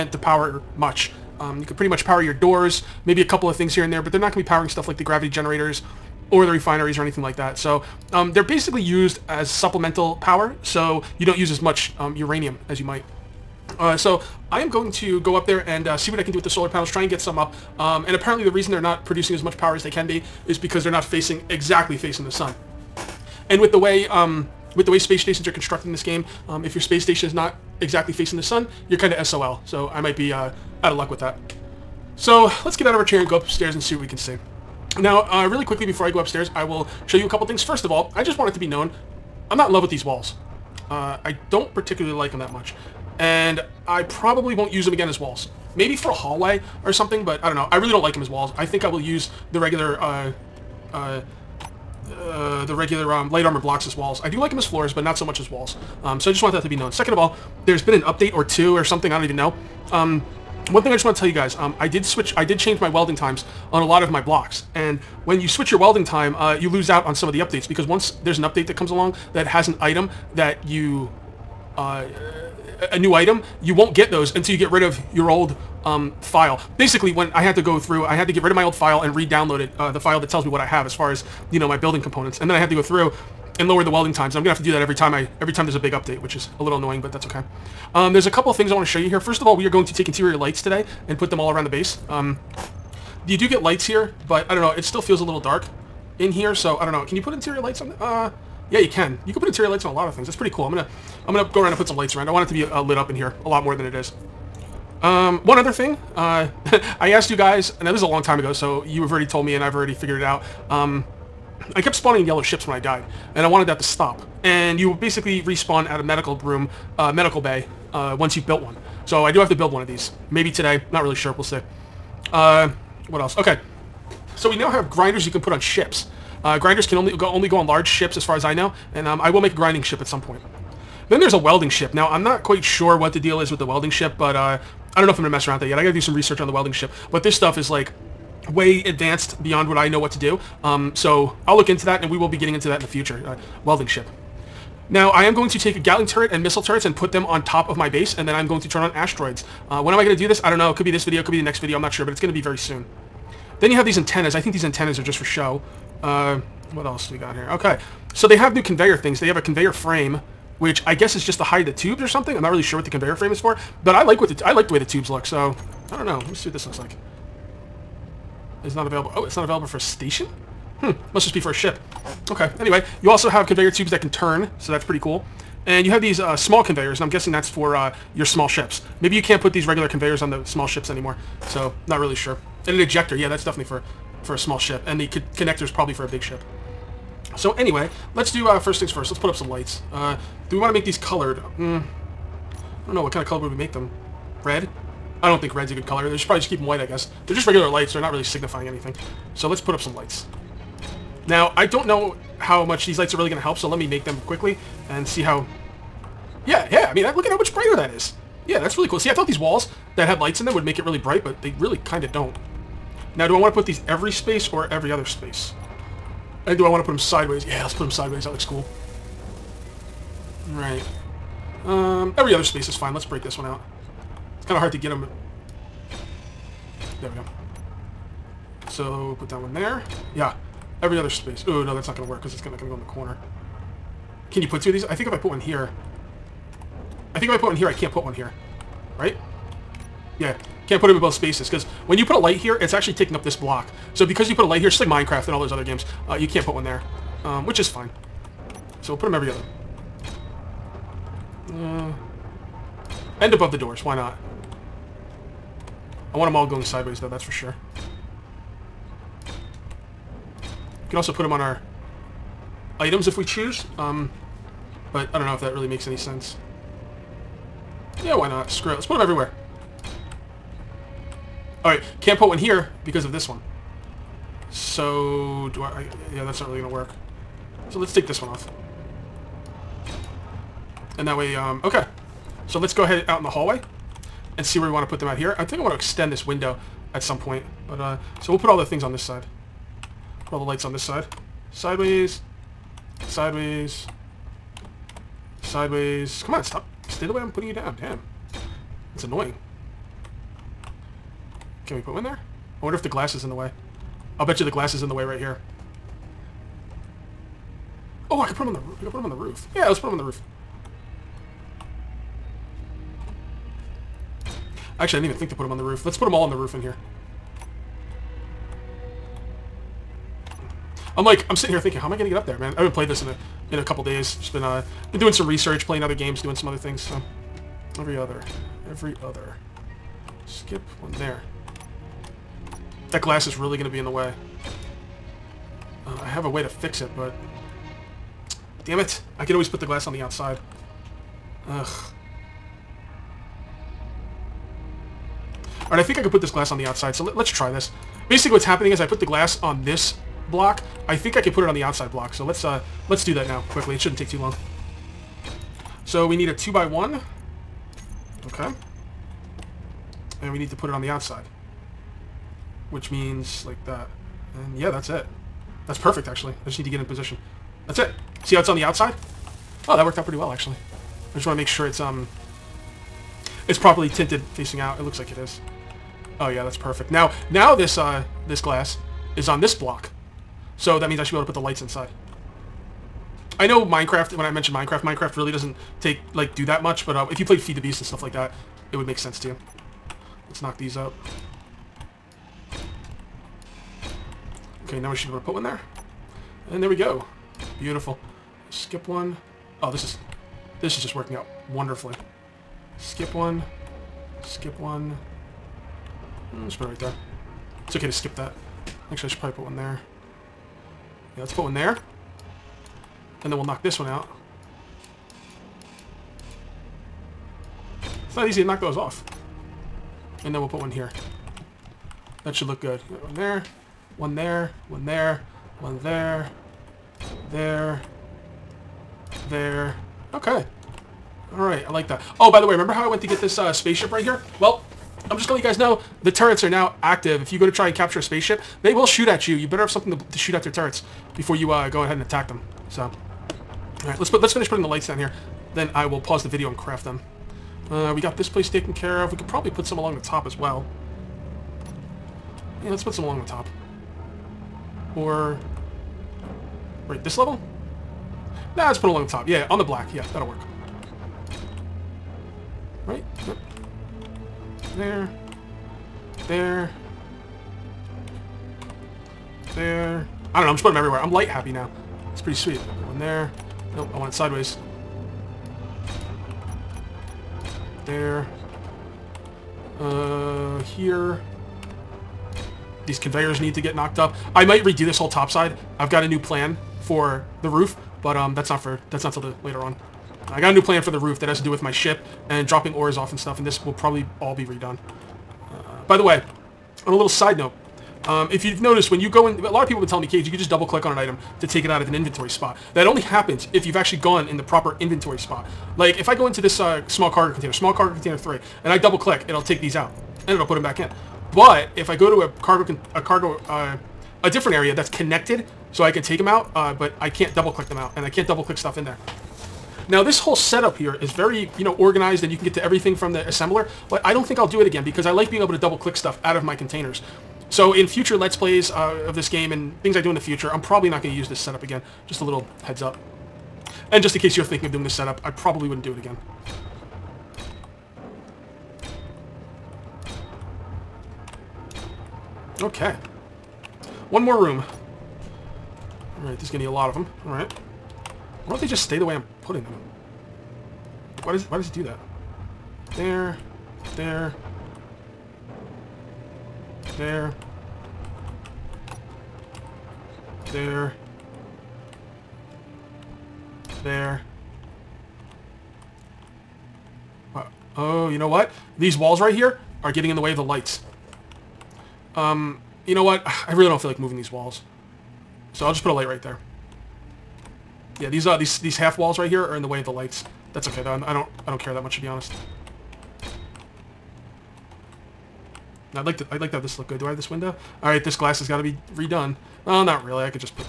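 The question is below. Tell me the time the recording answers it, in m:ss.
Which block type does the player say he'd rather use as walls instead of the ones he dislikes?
0:53.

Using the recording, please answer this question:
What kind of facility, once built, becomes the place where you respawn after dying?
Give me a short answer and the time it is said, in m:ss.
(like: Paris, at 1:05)
medical bay, at 1:57.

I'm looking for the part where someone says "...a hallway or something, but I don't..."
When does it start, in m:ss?
0:46.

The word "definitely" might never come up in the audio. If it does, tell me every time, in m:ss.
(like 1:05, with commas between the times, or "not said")
3:03.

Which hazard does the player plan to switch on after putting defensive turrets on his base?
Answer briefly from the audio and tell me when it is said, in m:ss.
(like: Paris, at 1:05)
asteroids, at 2:28.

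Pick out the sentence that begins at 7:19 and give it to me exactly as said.
You better have something to, to shoot at their turrets before you uh, go ahead and attack them.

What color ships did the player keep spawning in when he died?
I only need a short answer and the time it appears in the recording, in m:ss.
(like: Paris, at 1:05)
yellow, at 1:52.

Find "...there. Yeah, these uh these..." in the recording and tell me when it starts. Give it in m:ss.
9:36.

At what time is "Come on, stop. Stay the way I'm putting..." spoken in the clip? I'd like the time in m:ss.
4:56.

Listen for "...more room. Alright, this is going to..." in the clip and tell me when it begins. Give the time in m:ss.
9:04.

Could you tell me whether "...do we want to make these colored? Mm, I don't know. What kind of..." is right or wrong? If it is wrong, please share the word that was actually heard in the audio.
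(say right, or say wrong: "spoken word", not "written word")
right.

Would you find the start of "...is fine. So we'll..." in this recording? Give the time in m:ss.
4:07.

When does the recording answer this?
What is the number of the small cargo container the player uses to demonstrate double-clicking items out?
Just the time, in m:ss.
8:27.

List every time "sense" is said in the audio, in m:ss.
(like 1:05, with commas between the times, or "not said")
4:25, 6:28.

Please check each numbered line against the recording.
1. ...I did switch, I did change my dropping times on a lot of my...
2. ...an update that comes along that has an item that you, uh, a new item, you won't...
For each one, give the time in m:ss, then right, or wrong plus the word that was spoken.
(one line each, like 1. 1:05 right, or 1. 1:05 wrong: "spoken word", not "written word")
1. 1:01 wrong: "welding", not "dropping"
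2. 1:08 right.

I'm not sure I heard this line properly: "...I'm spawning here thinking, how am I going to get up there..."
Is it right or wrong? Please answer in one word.
wrong.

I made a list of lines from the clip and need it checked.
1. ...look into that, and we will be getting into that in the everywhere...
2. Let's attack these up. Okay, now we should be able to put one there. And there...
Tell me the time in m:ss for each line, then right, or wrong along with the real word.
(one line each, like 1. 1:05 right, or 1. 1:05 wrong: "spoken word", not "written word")
1. 2:21 wrong: "future", not "everywhere"
2. 6:30 wrong: "knock", not "attack".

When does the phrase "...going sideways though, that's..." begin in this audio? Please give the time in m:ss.
4:16.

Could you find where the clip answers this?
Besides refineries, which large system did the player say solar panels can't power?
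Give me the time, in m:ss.
0:05.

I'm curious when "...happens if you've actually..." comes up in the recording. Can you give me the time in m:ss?
8:22.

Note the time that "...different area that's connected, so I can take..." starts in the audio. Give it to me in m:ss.
8:34.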